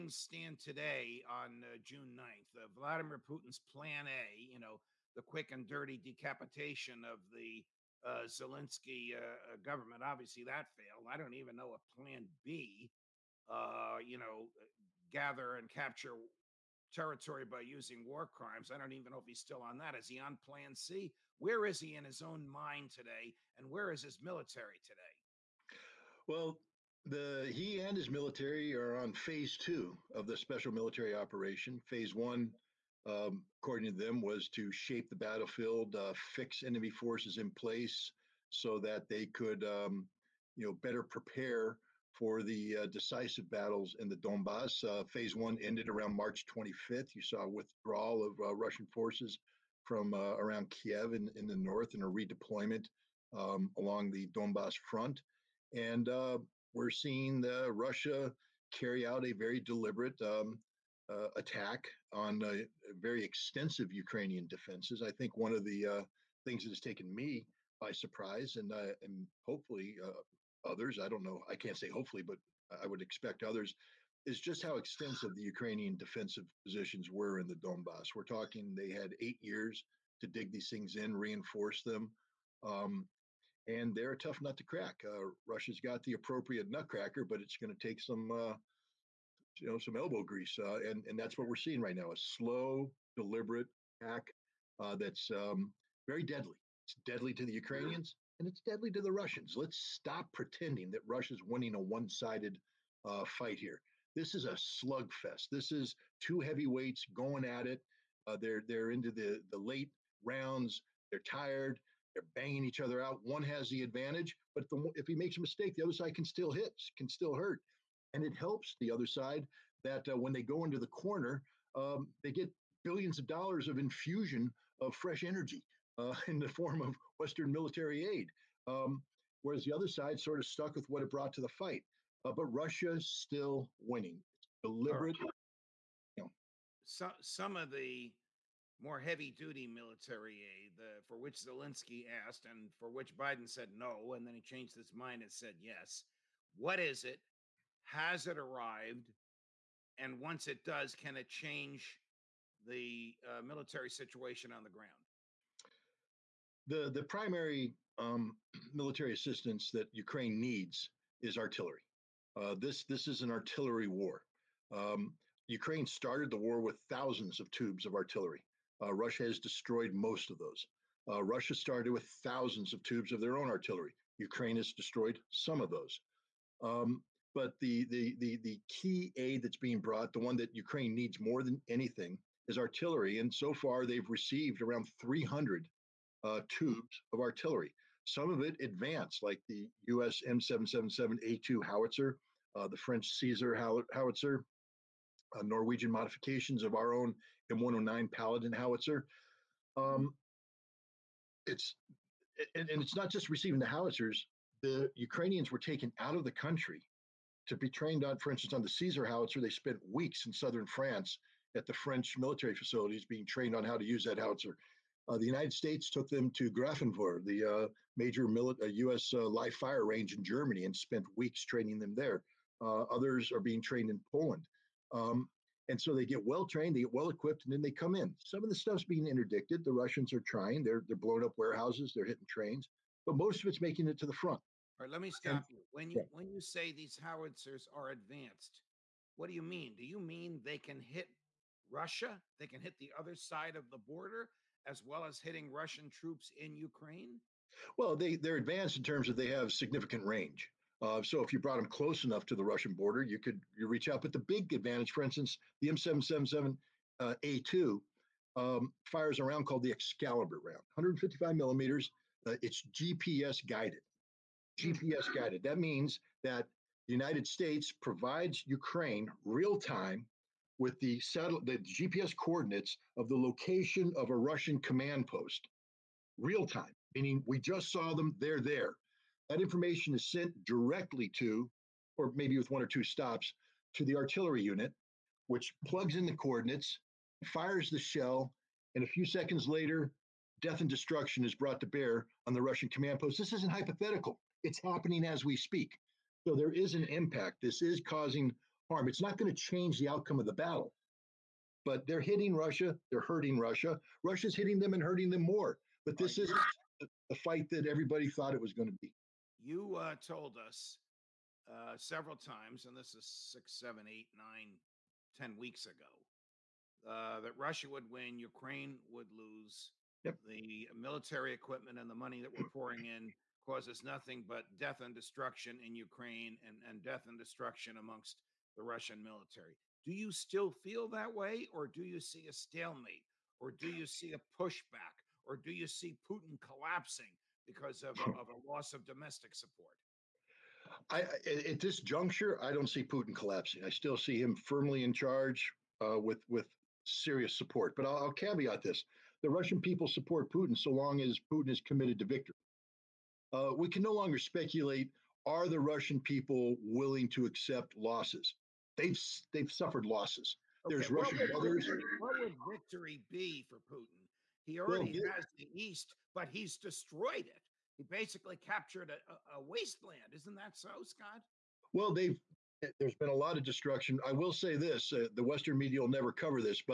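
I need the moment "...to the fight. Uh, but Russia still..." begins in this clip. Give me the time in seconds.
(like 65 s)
131 s.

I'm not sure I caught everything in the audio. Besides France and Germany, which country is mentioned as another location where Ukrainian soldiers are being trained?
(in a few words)
Poland.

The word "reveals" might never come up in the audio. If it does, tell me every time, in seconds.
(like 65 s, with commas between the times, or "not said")
not said.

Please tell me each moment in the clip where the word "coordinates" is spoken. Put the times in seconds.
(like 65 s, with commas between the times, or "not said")
272 s, 286 s.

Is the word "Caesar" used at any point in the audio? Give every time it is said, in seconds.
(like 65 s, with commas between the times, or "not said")
193 s, 208 s.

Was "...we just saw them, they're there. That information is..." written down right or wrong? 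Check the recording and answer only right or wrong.
right.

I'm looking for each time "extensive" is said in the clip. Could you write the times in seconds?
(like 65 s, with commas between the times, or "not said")
63 s, 74 s.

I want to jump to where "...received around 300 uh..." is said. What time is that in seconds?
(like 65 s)
184 s.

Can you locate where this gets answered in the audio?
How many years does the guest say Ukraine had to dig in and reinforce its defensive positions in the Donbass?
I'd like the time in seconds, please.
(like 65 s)
79 s.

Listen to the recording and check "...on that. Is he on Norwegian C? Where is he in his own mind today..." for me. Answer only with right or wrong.
wrong.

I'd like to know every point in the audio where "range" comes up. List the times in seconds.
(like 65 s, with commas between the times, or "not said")
219 s, 250 s.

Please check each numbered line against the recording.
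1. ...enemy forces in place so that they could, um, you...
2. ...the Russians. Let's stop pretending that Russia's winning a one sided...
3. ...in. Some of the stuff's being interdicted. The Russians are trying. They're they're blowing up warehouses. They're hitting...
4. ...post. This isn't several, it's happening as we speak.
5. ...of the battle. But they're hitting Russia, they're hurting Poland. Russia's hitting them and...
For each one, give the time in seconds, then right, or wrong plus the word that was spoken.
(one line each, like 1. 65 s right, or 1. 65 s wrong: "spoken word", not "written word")
1. 36 s right
2. 99 s right
3. 227 s right
4. 292 s wrong: "hypothetical", not "several"
5. 300 s wrong: "Russia", not "Poland".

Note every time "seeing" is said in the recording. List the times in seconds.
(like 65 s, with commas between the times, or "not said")
56 s, 91 s.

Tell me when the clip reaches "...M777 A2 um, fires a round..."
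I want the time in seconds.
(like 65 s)
255 s.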